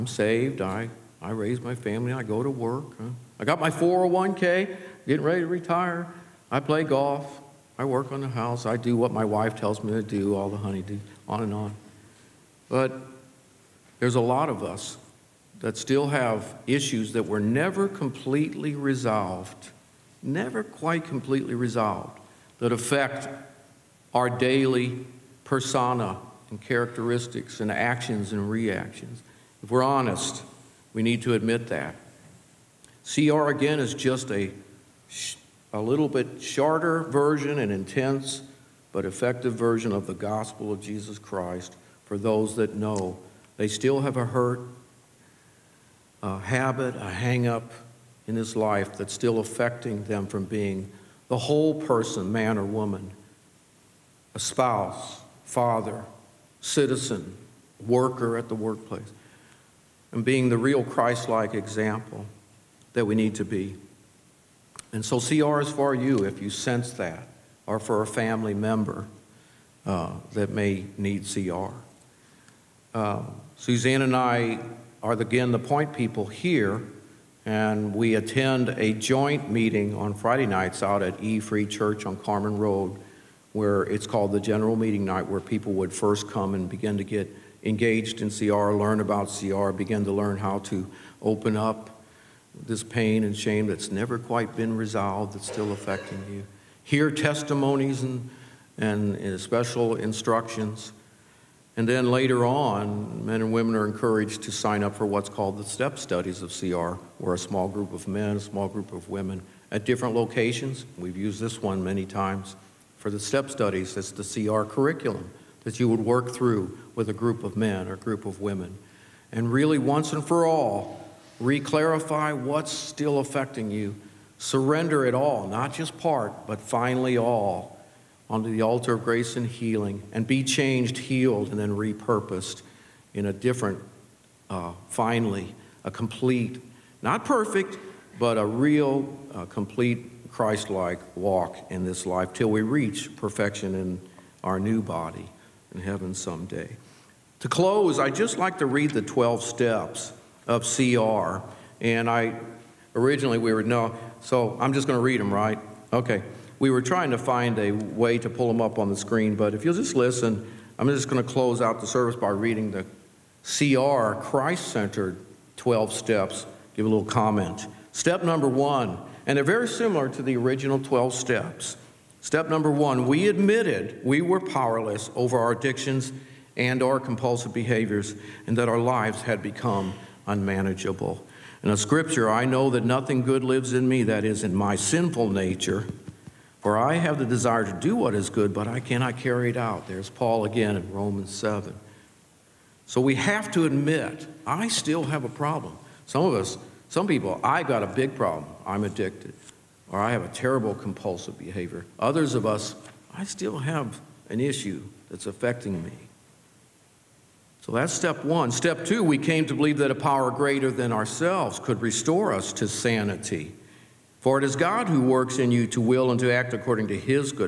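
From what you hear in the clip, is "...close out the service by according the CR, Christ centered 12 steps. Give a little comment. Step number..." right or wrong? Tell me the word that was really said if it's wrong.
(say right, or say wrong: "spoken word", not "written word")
wrong: "reading", not "according".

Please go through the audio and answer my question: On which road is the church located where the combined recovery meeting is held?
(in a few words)
Carmen Road.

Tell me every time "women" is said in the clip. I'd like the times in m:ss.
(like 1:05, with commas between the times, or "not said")
1:43, 1:49, 1:58.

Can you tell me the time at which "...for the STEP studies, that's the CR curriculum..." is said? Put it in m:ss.
1:52.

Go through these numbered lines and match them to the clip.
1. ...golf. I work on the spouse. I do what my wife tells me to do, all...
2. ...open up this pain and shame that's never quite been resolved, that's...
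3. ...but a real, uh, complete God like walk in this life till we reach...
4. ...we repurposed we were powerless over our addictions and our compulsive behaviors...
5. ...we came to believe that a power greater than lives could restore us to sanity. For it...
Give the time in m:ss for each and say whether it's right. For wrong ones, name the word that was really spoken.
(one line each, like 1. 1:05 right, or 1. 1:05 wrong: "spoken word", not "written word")
1. 0:06 wrong: "house", not "spouse"
2. 1:31 right
3. 2:18 wrong: "Christ", not "God"
4. 2:53 wrong: "admitted", not "repurposed"
5. 3:29 wrong: "ourselves", not "lives".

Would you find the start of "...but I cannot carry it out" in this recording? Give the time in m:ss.
3:08.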